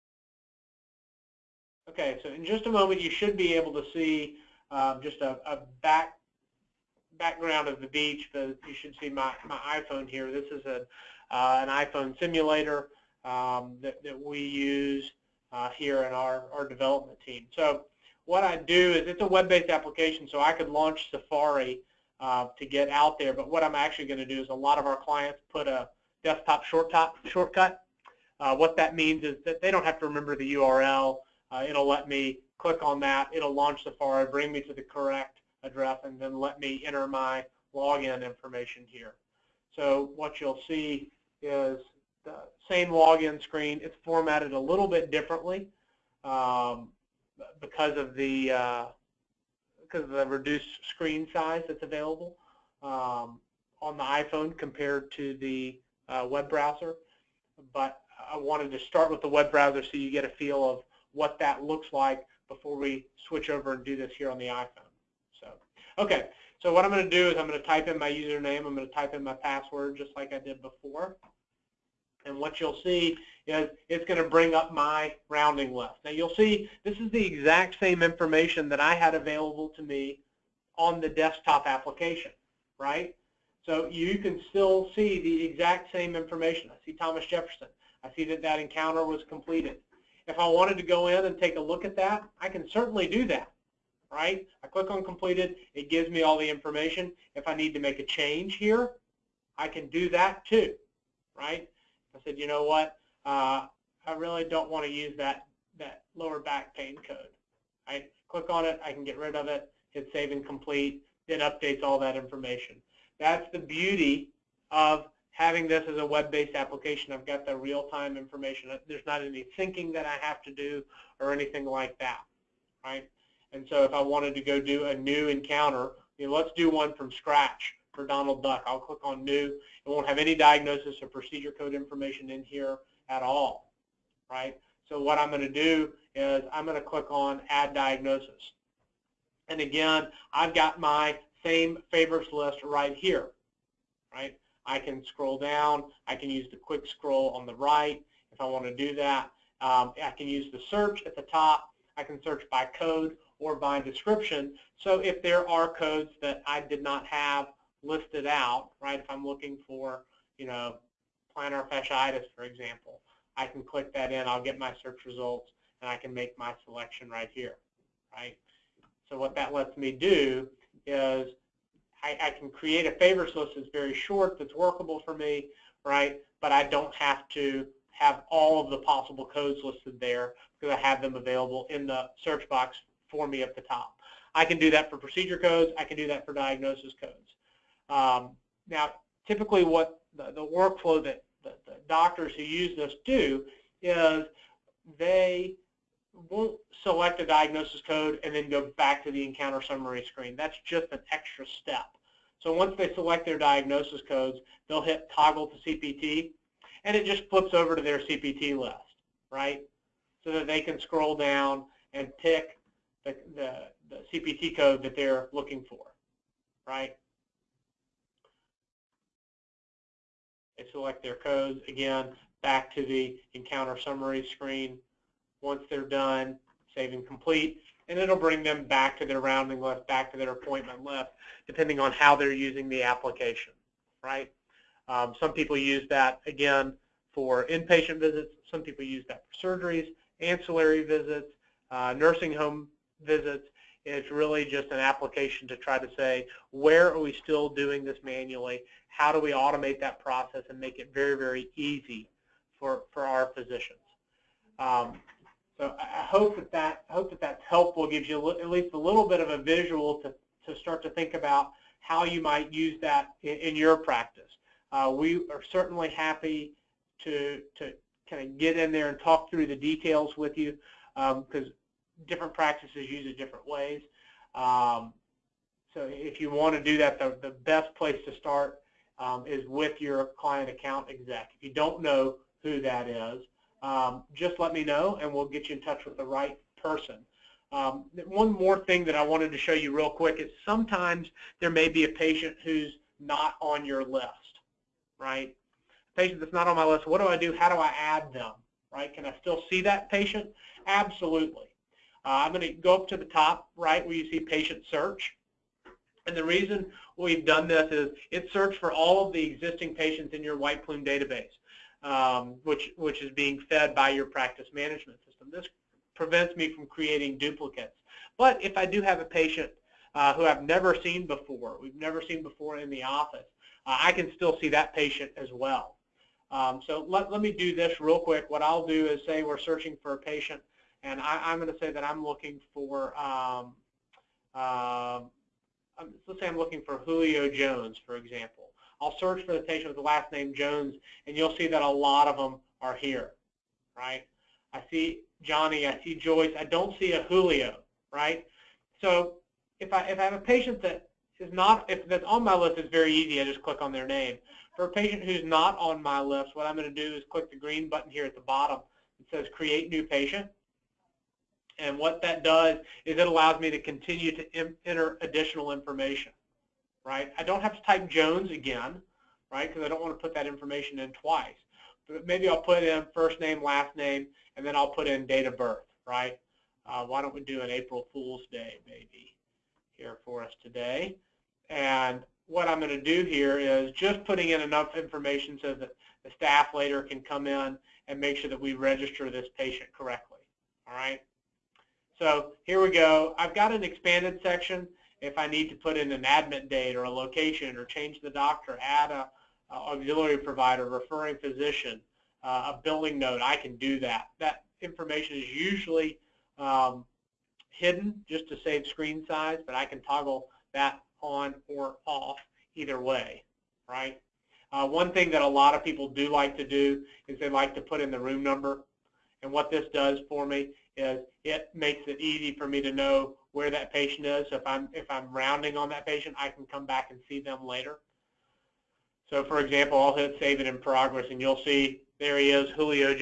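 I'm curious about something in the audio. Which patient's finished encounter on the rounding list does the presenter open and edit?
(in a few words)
Thomas Jefferson.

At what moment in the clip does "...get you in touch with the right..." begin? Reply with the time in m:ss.
4:45.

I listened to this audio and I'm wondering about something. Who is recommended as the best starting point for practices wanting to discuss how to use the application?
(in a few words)
client account exec.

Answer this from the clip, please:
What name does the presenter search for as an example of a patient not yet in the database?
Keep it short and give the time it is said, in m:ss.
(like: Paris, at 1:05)
Julio Jones, at 5:36.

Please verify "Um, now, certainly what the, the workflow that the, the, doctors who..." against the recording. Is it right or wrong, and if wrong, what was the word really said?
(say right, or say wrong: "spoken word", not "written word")
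wrong: "typically", not "certainly".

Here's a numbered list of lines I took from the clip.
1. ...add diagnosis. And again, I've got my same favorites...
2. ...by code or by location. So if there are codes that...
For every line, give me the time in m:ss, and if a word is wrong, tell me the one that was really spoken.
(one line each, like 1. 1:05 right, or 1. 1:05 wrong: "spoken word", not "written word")
1. 2:17 right
2. 2:32 wrong: "description", not "location".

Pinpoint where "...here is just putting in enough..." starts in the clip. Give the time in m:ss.
6:23.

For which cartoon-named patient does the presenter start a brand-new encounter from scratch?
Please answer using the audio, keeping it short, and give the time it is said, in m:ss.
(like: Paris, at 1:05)
Donald Duck, at 2:08.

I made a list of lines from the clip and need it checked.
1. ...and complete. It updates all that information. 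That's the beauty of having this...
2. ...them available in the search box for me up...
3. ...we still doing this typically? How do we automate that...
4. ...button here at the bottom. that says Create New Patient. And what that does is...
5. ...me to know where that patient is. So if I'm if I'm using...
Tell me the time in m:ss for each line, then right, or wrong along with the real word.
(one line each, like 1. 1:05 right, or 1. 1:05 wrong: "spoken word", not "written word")
1. 1:50 right
2. 3:01 right
3. 4:06 wrong: "manually", not "typically"
4. 5:57 right
5. 7:02 wrong: "rounding", not "using".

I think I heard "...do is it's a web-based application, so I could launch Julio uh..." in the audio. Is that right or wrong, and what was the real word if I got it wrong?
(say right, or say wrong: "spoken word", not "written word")
wrong: "Safari", not "Julio".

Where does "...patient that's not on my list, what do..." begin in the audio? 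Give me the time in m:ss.
4:56.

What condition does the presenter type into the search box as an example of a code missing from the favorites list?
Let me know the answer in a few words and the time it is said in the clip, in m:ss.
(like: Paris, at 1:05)
plantar fasciitis, at 2:41.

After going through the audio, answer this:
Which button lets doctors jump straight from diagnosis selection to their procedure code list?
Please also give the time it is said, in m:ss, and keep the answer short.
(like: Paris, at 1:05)
toggle to CPT, at 3:25.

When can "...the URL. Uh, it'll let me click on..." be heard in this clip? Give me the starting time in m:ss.
0:30.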